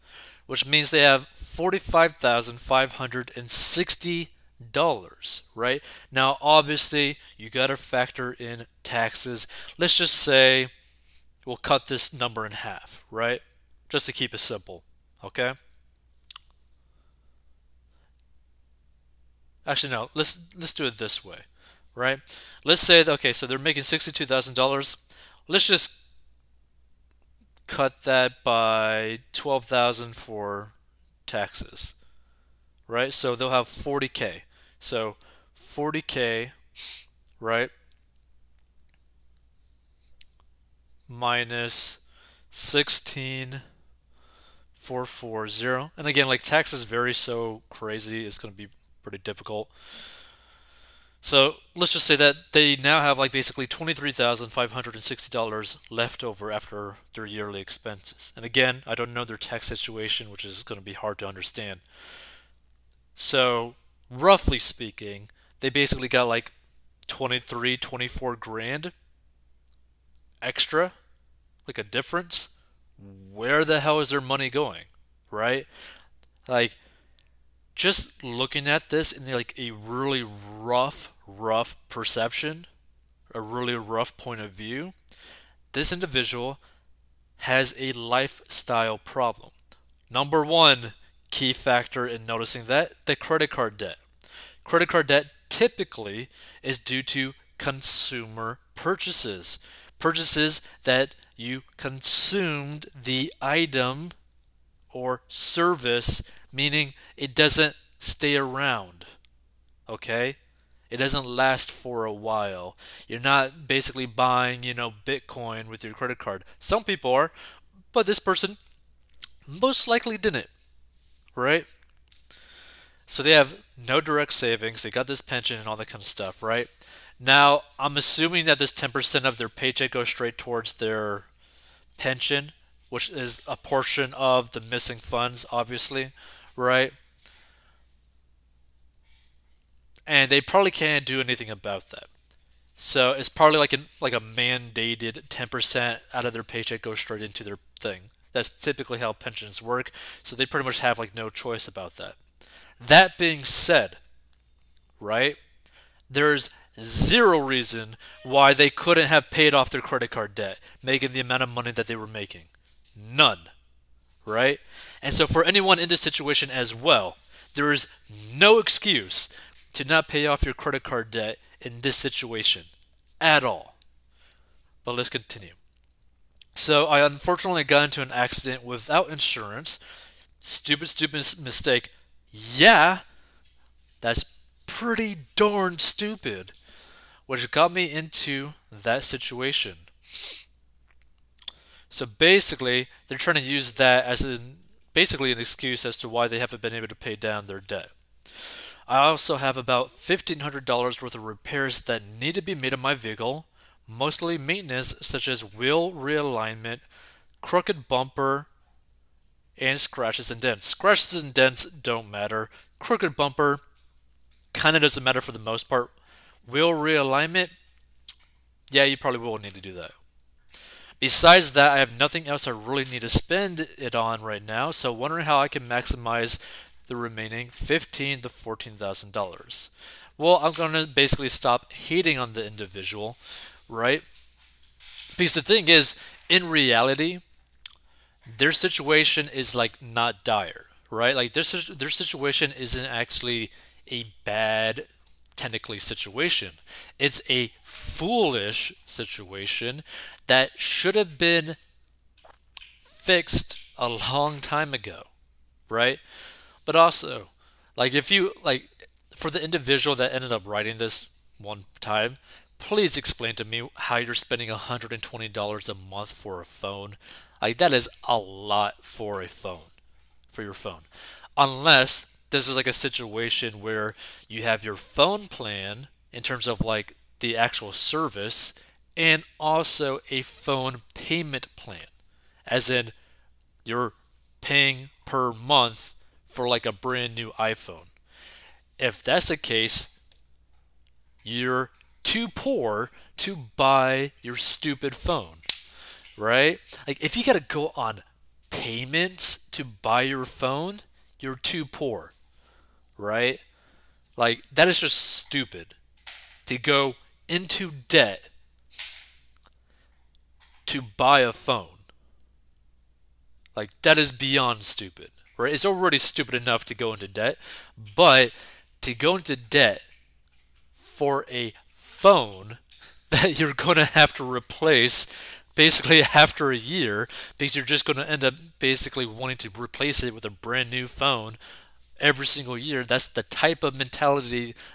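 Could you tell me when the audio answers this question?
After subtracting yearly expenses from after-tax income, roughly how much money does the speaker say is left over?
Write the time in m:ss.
0:53.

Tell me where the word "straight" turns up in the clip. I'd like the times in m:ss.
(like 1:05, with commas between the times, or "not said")
2:10, 2:26.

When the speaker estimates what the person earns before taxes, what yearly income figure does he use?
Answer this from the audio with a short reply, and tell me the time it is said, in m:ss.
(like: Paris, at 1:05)
$62,000, at 0:23.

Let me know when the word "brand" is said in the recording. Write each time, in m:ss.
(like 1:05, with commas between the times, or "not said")
4:46, 5:30.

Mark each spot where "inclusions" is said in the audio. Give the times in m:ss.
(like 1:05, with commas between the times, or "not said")
not said.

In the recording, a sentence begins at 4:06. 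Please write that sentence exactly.
It's a foolish situation that should have been fixed a long time ago, right?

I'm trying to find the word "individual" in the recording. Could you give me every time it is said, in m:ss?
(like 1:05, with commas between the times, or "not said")
1:25, 3:52, 4:19.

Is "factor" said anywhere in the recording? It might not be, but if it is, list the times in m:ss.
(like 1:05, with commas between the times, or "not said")
0:07, 1:31.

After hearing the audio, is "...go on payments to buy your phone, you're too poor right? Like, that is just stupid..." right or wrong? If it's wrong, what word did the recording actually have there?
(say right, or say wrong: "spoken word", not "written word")
right.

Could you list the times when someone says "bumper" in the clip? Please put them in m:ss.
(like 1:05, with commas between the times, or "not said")
3:27, 3:33.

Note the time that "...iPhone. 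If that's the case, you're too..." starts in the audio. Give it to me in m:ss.
4:47.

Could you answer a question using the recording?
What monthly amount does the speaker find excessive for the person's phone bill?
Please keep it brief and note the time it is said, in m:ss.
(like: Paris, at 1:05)
$120, at 4:24.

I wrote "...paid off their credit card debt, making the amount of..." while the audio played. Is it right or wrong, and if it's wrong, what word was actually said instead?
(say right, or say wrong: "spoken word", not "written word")
right.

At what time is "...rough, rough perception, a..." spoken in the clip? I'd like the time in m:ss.
1:20.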